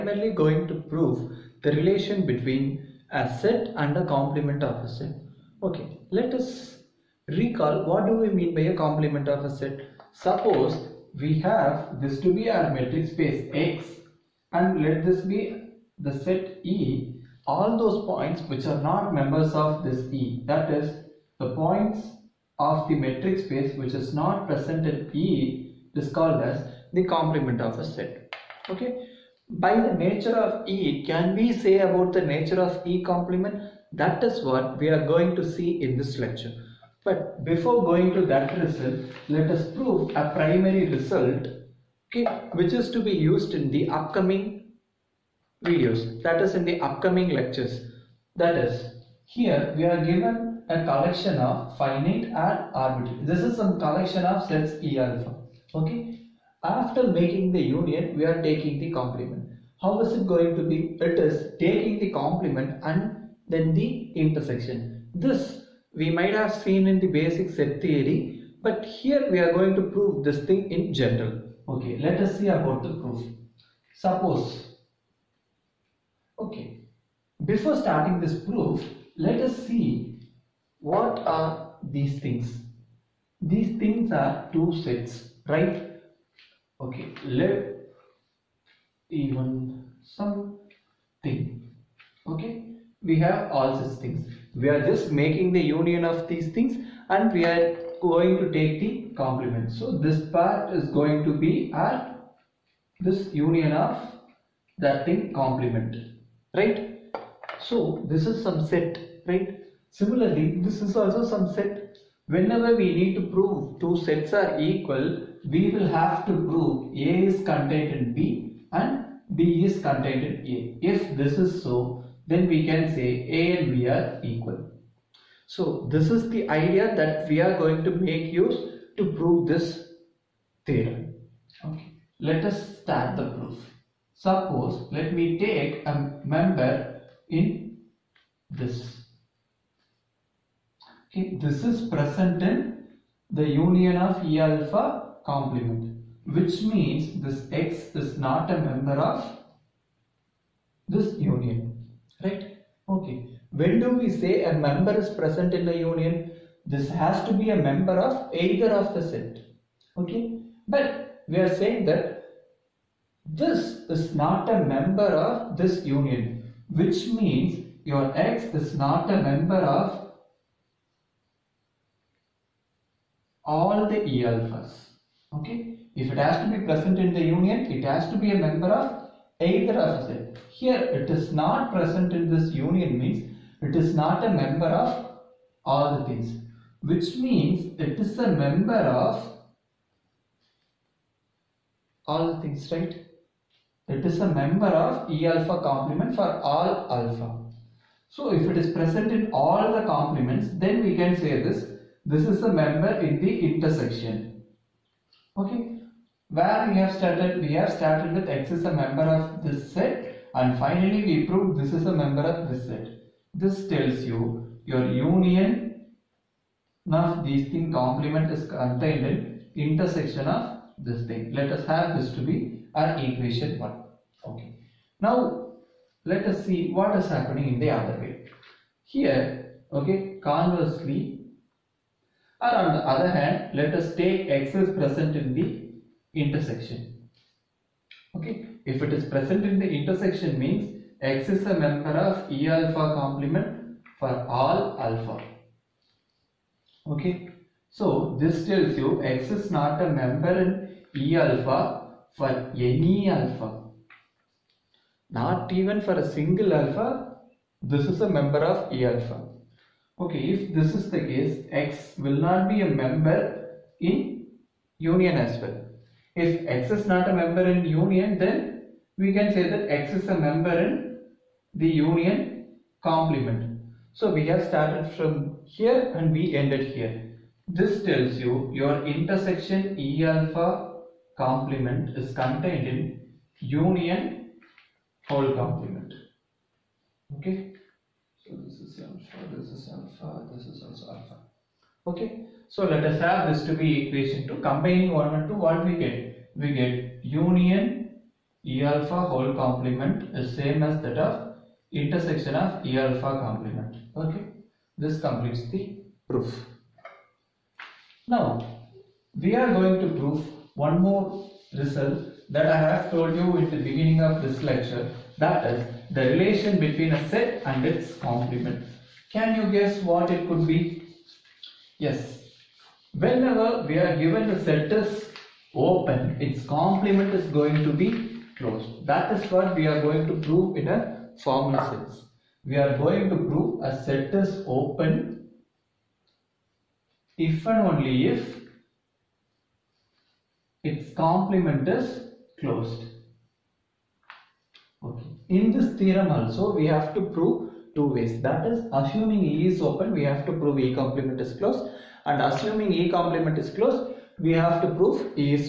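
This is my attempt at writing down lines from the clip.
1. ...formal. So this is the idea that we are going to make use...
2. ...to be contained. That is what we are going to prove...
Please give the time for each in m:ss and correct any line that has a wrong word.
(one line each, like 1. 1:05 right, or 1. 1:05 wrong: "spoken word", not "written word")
1. 2:04 wrong: "equal", not "formal"
2. 5:27 wrong: "closed", not "contained".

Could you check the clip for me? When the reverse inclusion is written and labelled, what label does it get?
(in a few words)
equation 2.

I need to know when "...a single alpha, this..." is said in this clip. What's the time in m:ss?
4:15.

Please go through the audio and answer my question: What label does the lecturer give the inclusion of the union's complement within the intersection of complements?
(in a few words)
equation 1.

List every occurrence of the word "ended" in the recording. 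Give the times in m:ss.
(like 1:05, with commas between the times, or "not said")
4:36.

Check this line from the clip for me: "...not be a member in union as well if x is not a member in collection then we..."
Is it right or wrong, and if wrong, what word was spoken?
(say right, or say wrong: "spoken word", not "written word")
wrong: "union", not "collection".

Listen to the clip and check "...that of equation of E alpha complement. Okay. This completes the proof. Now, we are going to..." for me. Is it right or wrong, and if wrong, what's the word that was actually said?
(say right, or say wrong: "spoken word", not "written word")
wrong: "intersection", not "equation".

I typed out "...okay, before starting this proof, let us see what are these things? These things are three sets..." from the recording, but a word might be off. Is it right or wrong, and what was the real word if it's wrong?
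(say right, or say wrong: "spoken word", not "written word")
wrong: "two", not "three".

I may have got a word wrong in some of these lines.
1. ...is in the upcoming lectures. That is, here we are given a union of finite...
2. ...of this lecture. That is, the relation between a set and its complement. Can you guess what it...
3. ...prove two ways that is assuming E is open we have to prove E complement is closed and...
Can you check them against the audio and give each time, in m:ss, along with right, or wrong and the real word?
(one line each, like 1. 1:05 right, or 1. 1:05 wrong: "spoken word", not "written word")
1. 0:46 wrong: "collection", not "union"
2. 5:14 right
3. 5:47 right.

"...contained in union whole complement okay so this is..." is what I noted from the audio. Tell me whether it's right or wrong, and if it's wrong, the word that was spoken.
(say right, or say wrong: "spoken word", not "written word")
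right.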